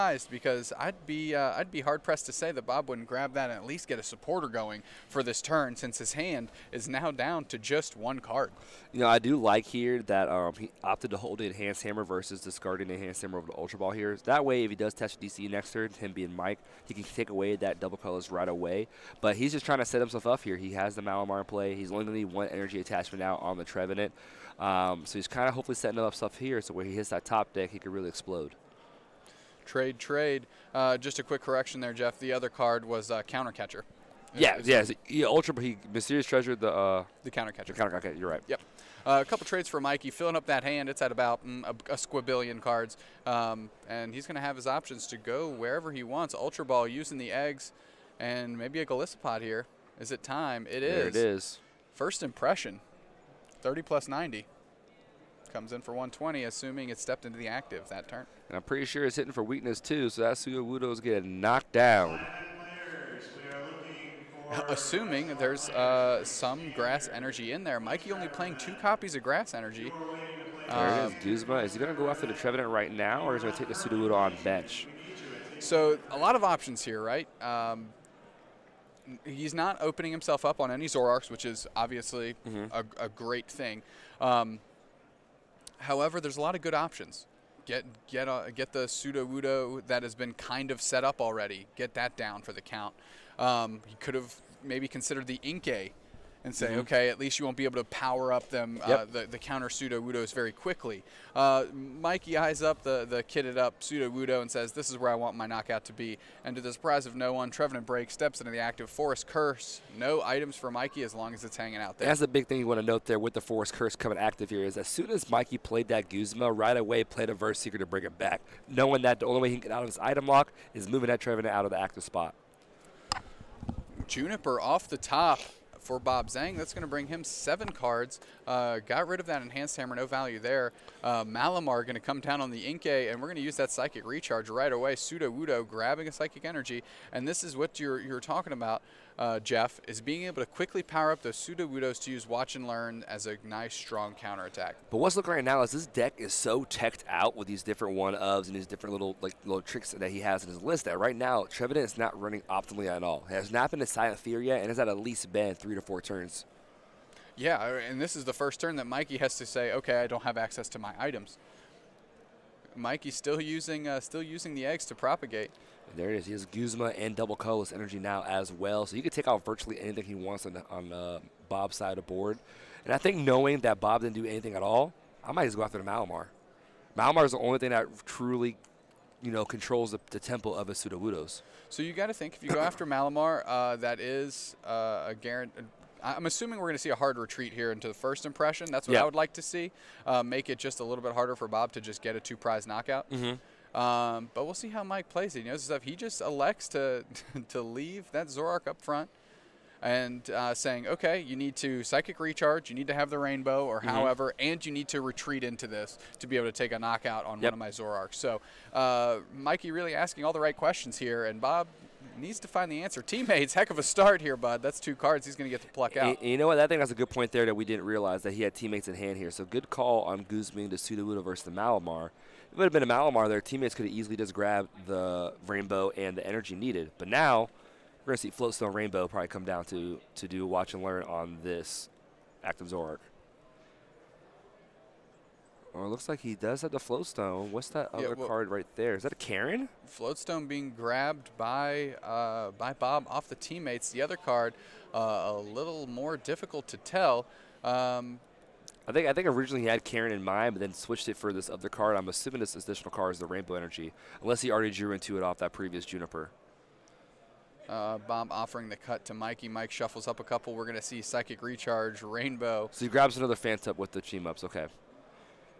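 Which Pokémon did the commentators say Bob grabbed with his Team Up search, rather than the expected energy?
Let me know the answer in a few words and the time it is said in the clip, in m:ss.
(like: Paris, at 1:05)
Phantump, at 4:23.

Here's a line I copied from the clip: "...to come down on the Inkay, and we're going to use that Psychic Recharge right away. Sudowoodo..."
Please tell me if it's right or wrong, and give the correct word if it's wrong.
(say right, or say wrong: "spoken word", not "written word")
right.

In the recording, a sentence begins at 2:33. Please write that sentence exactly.
It has not been a silent fear yet and has at least been three to four turns.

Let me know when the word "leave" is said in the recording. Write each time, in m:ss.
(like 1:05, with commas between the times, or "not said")
3:17.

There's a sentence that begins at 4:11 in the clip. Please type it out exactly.
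I'm assuming this additional card is the Rainbow Energy, unless he already drew into it off that previous Juniper.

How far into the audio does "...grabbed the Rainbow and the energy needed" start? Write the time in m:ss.
3:44.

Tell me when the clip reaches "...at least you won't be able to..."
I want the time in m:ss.
1:37.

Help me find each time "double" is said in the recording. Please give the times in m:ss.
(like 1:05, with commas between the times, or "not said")
0:17, 2:47.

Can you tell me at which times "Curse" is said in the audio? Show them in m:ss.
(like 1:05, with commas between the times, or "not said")
1:49, 1:53.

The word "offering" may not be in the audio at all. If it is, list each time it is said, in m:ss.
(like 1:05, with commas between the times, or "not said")
4:18.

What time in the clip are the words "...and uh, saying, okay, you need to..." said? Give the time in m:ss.
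3:19.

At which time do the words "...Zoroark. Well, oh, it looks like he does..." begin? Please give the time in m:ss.
3:52.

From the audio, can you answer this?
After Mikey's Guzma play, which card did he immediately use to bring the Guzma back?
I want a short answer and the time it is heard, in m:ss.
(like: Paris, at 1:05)
Verse Seeker, at 1:57.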